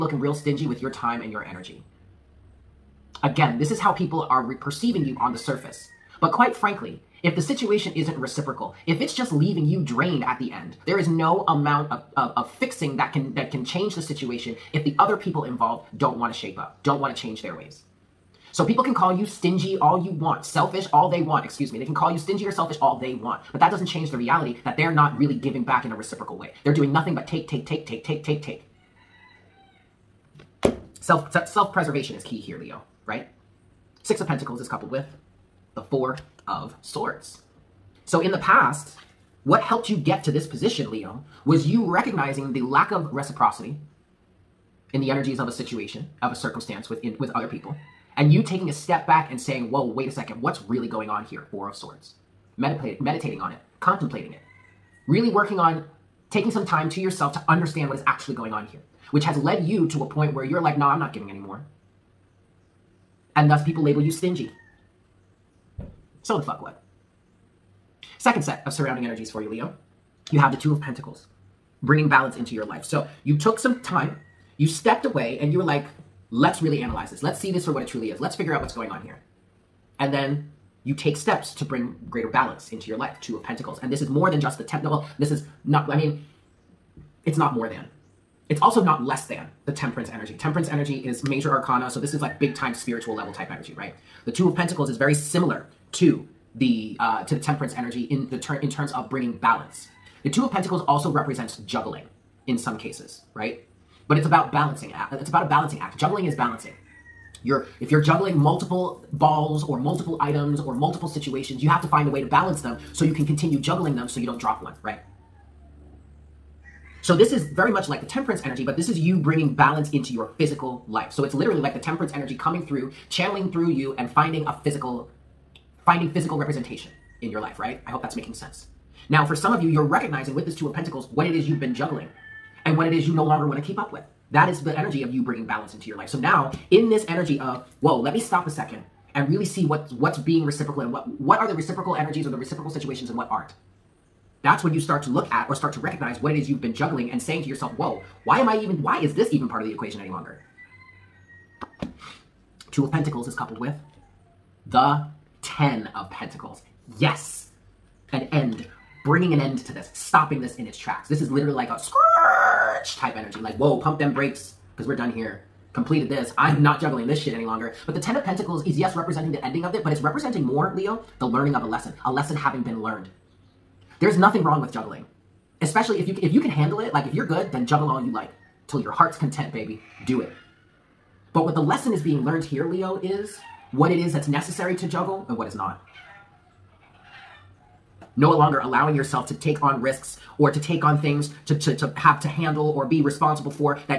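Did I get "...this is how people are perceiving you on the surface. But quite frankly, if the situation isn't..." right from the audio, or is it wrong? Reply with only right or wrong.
right.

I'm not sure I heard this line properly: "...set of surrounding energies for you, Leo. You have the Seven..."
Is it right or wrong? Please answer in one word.
wrong.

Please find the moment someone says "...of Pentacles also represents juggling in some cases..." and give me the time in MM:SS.
01:40.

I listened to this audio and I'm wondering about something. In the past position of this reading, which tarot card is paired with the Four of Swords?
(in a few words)
Six of Pentacles.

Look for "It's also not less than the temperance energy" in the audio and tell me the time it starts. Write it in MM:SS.
01:28.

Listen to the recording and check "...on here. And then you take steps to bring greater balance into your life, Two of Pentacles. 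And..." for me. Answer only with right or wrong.
right.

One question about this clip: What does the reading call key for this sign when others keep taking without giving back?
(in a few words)
Self-preservation.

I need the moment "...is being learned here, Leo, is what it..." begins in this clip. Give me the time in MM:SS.
03:01.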